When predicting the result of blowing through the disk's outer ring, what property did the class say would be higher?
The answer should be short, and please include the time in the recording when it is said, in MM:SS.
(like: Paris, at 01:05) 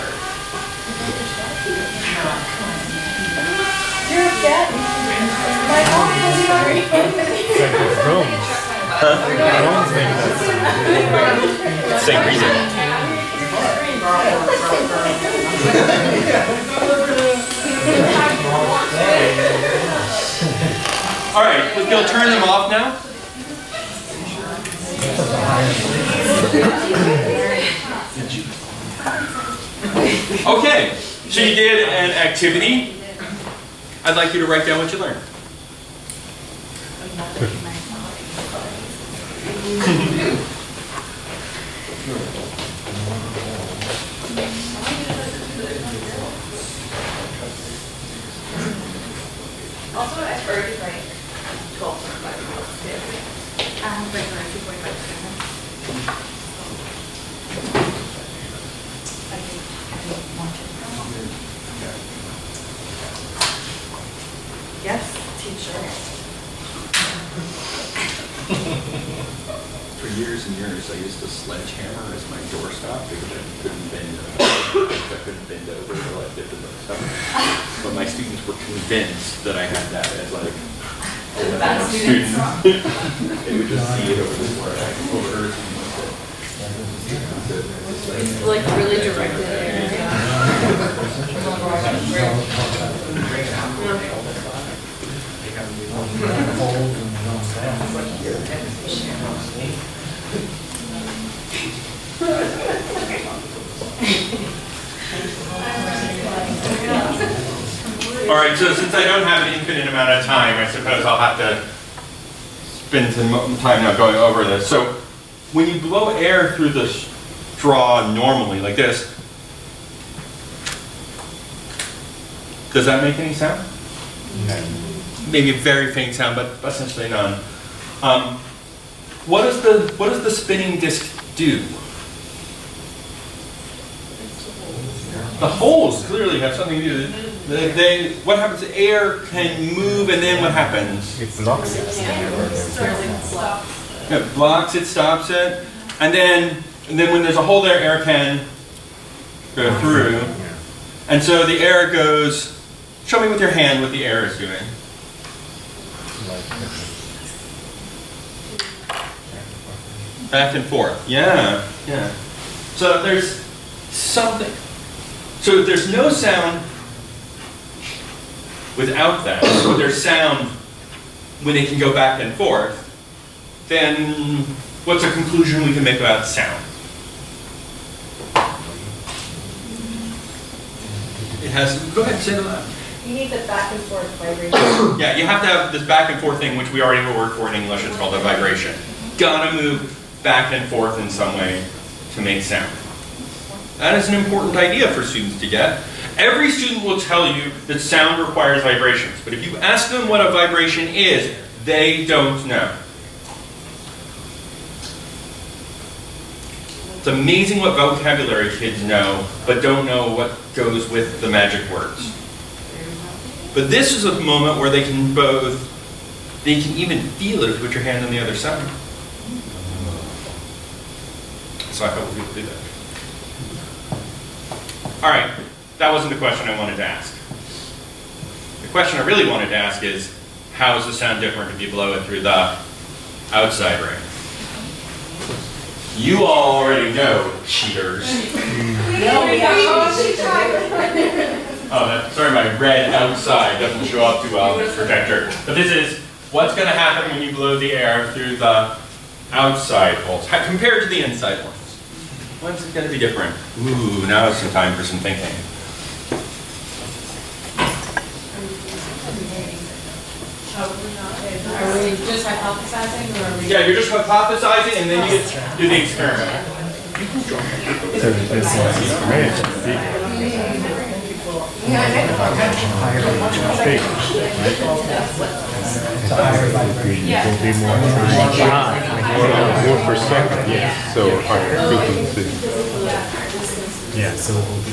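frequency, at 04:41.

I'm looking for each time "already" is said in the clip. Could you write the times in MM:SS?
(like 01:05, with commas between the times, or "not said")
03:06, 03:56.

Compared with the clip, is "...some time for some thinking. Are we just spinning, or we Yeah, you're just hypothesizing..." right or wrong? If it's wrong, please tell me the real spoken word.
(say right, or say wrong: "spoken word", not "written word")
wrong: "hypothesizing", not "spinning".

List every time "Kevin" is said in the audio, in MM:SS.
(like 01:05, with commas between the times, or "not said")
not said.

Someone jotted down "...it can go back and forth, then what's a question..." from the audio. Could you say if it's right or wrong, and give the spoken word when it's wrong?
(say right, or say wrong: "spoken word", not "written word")
wrong: "conclusion", not "question".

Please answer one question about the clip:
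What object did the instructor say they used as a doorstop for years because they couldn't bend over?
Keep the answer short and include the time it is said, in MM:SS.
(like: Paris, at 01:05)
sledgehammer, at 01:11.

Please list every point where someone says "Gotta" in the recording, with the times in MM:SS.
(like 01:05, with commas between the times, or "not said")
03:09.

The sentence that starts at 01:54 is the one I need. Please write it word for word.
So when you blow air through the straw normally, like this, does that make any sound?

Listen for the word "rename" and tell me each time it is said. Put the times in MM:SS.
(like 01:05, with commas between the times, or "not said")
not said.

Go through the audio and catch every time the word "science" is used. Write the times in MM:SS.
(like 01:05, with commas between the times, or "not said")
not said.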